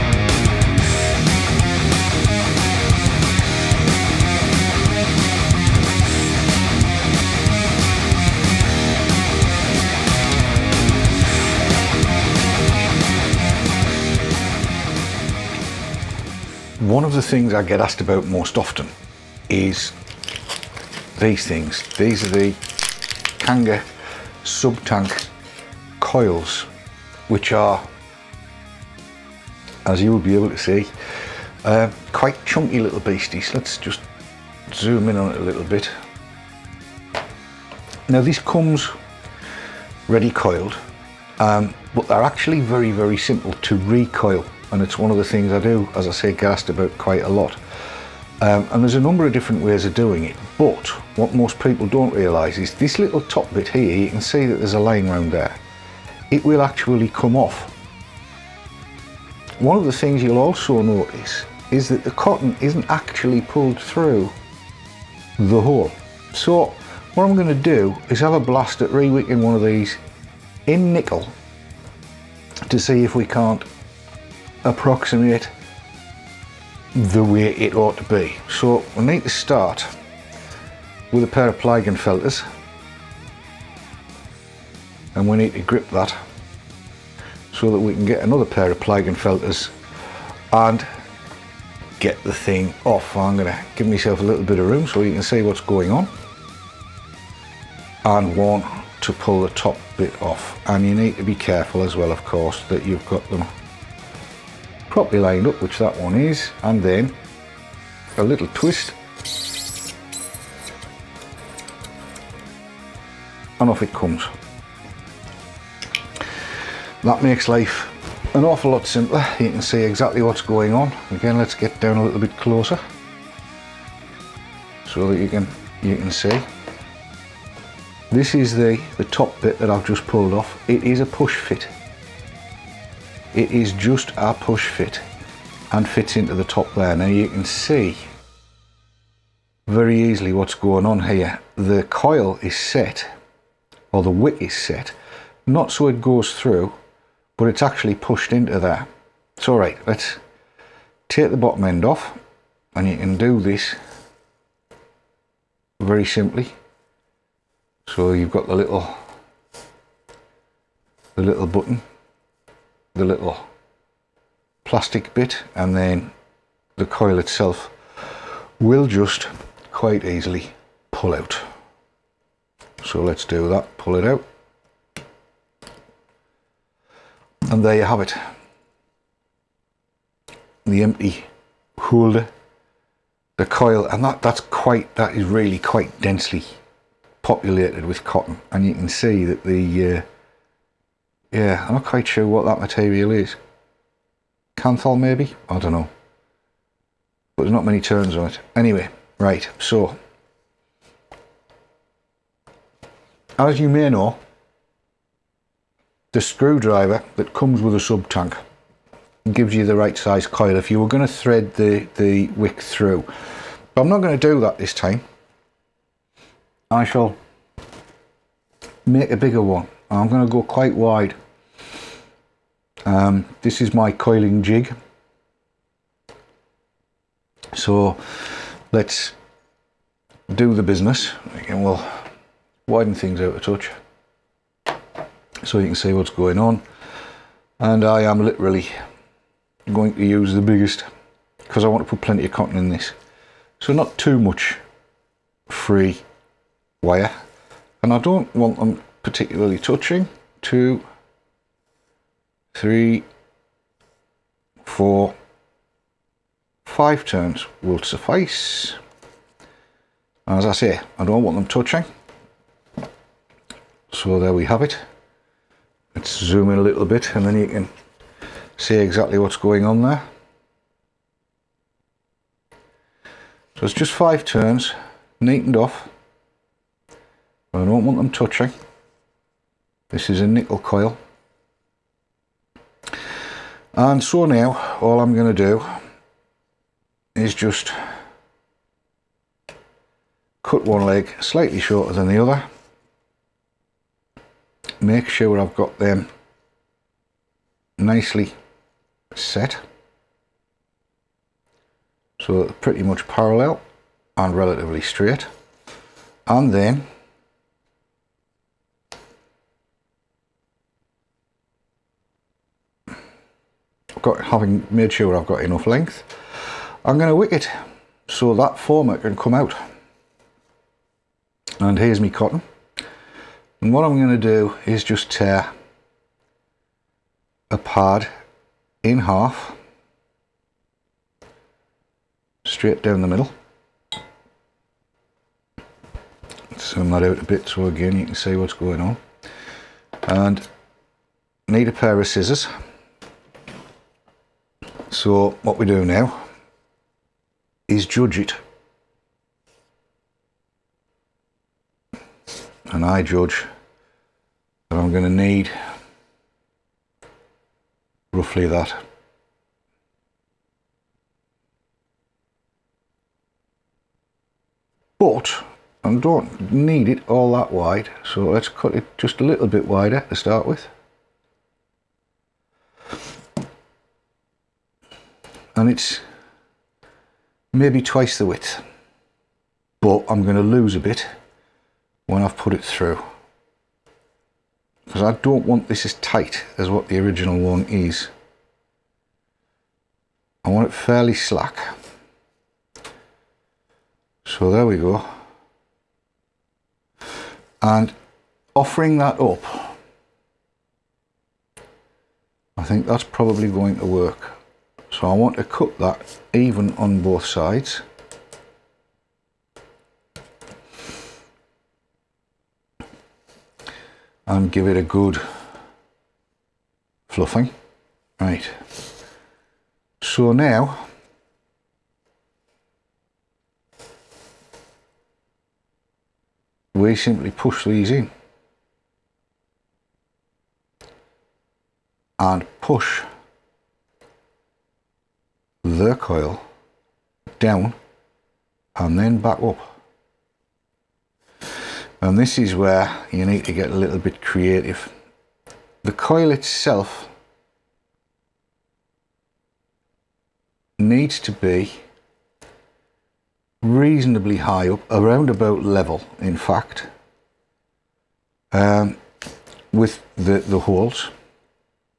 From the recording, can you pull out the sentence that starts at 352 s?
And I judge that I'm going to need roughly that.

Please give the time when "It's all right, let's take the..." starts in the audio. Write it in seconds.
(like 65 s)
149 s.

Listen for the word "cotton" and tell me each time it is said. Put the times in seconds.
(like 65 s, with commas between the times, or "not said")
62 s, 188 s, 242 s, 322 s.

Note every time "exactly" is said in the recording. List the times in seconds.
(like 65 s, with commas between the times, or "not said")
119 s, 268 s.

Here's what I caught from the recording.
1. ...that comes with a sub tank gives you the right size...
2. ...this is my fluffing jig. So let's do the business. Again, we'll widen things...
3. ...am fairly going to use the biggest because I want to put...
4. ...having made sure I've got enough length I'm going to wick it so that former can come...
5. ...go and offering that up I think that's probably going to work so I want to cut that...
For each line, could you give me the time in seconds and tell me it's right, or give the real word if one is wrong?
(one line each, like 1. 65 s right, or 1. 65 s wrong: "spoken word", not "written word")
1. 207 s right
2. 223 s wrong: "coiling", not "fluffing"
3. 238 s wrong: "literally", not "fairly"
4. 314 s right
5. 394 s right.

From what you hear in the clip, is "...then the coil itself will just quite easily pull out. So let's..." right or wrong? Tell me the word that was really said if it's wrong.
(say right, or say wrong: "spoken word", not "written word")
right.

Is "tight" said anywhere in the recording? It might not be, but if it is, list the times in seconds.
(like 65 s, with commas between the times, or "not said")
385 s.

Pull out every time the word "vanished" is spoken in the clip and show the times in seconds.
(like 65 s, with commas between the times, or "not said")
not said.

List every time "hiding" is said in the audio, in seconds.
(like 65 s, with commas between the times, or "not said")
not said.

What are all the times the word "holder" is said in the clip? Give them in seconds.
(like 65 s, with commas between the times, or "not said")
181 s.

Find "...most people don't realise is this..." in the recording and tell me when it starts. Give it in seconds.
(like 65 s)
51 s.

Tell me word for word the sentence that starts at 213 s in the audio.
But I'm not going to do that this time.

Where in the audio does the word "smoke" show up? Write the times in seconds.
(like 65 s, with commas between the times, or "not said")
not said.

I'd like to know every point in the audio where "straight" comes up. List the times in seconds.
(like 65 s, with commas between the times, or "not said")
304 s, 332 s.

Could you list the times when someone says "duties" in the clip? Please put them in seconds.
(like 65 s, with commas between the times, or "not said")
not said.